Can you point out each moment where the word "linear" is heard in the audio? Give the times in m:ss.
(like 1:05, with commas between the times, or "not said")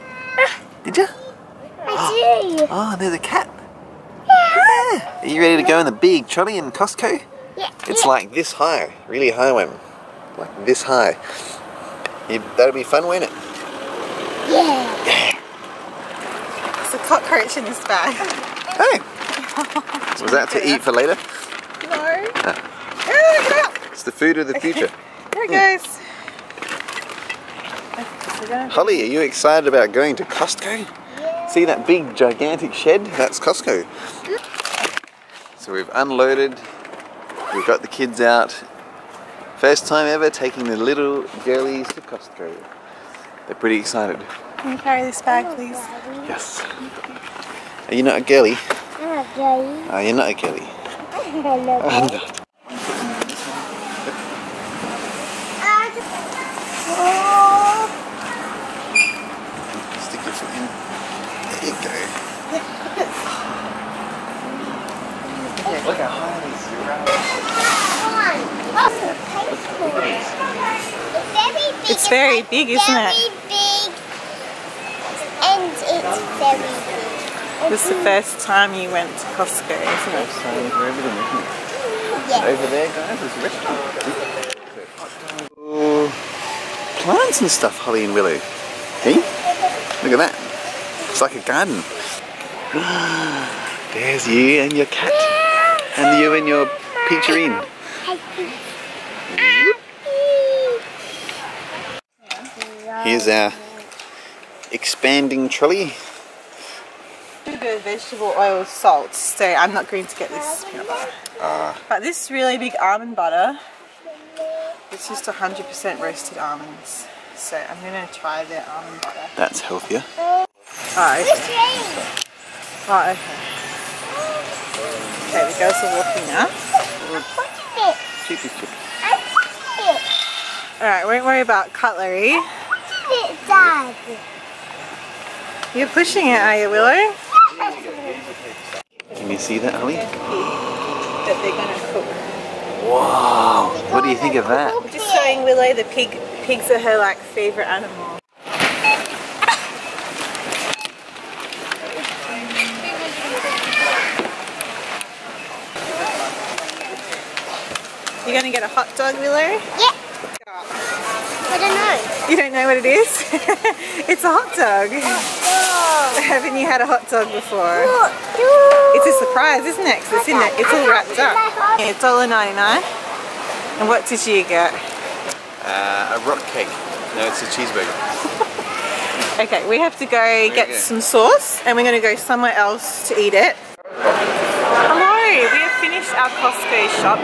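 not said.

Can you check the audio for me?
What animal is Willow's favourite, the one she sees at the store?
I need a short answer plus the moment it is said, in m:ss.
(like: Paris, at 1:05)
Pigs, at 2:26.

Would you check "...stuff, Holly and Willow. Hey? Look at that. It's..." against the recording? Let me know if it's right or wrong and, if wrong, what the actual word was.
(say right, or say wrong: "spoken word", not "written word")
right.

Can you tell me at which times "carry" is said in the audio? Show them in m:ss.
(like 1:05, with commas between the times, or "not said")
0:44.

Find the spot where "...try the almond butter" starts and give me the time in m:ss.
1:58.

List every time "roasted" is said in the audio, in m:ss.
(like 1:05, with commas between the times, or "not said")
1:55.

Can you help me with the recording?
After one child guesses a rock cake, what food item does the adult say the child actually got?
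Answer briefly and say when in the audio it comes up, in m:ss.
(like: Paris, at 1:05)
Cheeseburger, at 2:57.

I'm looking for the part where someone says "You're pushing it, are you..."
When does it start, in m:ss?
2:15.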